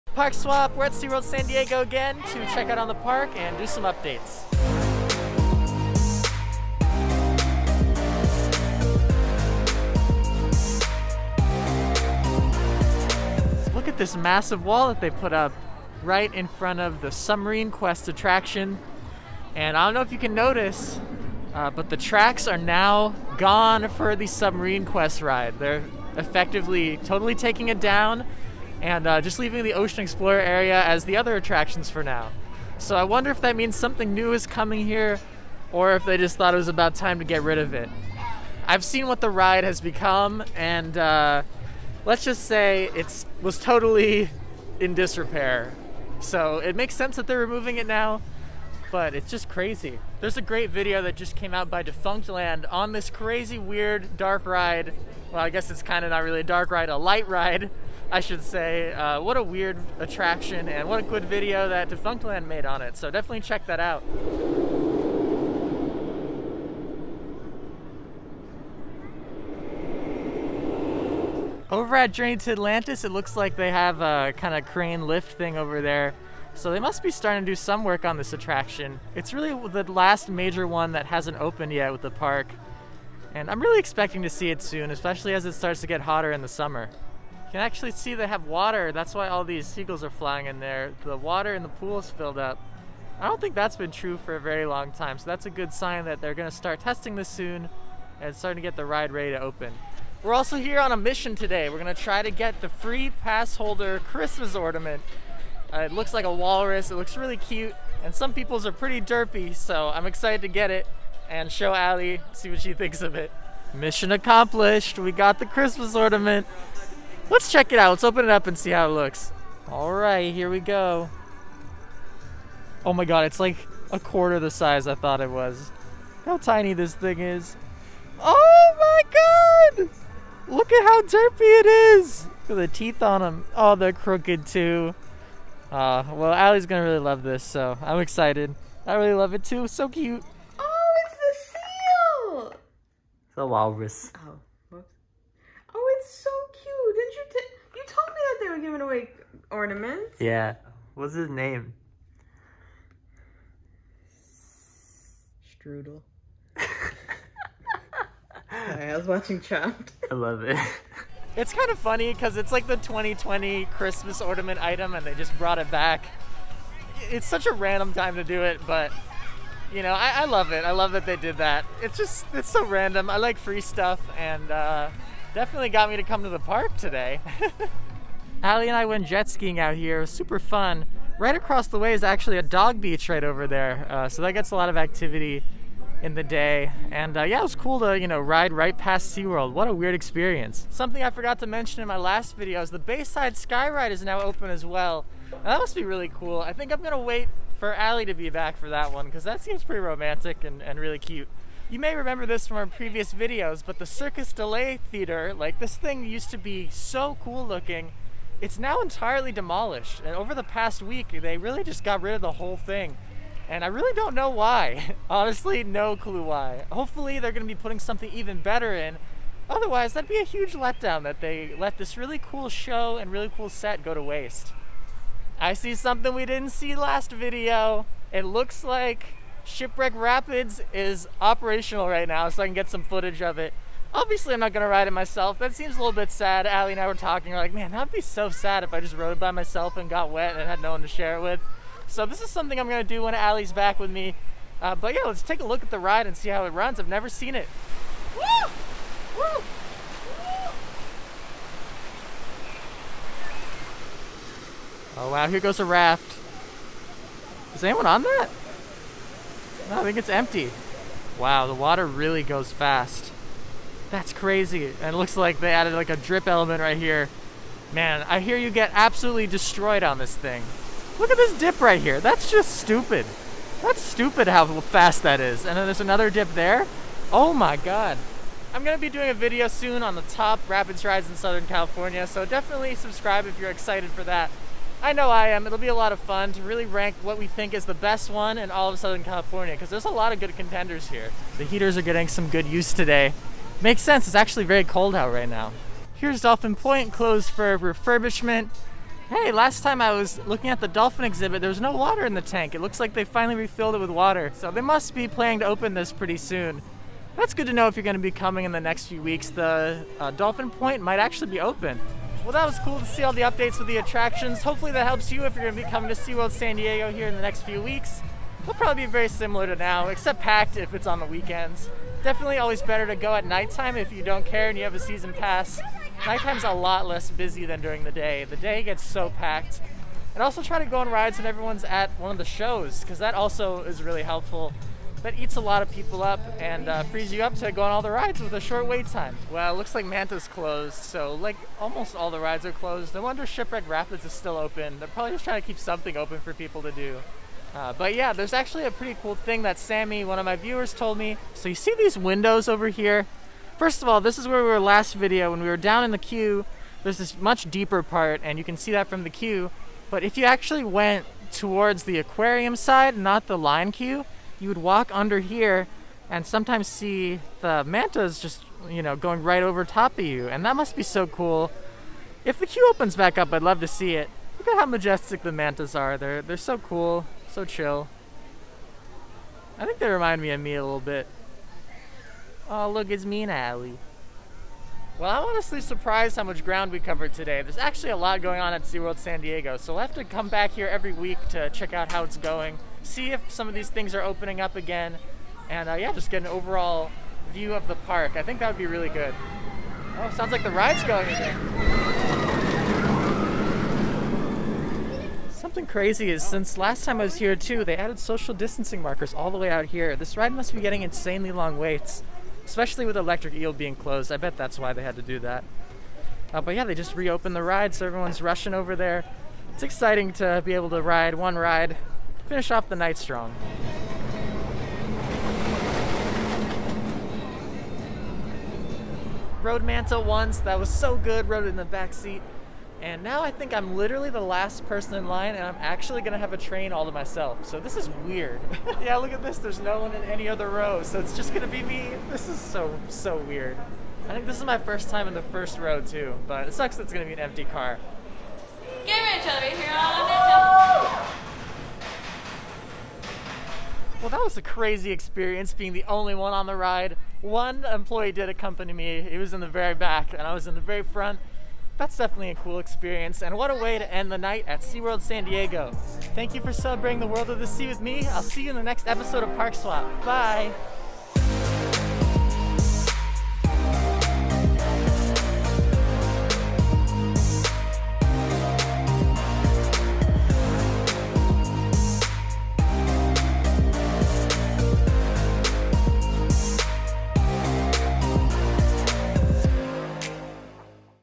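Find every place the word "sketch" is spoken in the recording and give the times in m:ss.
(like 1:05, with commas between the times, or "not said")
not said.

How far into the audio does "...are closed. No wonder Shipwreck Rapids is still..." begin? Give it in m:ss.
5:42.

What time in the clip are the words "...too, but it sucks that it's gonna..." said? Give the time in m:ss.
7:25.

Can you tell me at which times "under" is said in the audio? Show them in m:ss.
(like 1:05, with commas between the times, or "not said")
6:04.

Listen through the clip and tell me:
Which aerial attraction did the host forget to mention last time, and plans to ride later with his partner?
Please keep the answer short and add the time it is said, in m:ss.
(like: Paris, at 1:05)
Bayside Skyride, at 3:12.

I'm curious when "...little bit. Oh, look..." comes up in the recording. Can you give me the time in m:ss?
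6:20.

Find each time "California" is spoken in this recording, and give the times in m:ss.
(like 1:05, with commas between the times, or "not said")
4:41, 4:49.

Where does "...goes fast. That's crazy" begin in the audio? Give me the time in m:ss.
4:22.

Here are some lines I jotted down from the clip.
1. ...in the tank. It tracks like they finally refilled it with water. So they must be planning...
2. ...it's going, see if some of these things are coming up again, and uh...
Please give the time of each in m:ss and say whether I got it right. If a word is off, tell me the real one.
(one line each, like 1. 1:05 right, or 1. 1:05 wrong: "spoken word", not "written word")
1. 5:02 wrong: "looks", not "tracks"
2. 6:32 wrong: "opening", not "coming".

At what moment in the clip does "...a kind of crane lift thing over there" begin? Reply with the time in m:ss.
1:14.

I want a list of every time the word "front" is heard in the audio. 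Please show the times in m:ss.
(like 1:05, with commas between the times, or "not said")
0:16, 7:40.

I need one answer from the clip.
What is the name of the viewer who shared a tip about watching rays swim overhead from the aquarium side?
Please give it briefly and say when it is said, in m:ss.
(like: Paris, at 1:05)
Sammy, at 5:49.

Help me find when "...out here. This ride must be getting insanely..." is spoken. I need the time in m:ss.
6:49.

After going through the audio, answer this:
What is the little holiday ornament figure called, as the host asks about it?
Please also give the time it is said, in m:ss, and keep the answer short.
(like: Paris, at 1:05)
Strudel, at 2:35.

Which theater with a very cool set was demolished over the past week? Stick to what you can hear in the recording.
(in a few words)
Cirque De La Mer.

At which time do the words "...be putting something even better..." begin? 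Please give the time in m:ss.
3:37.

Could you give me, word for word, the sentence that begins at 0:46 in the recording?
So it makes sense that they're removing it now, but it's just crazy.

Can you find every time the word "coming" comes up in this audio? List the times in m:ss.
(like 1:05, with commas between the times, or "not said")
0:34, 5:08, 5:15.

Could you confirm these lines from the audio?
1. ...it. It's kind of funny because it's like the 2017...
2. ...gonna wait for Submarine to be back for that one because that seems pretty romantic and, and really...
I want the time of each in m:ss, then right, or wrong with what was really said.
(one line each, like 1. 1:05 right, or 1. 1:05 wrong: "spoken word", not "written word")
1. 2:40 wrong: "2020", not "2017"
2. 3:16 wrong: "Ally", not "Submarine".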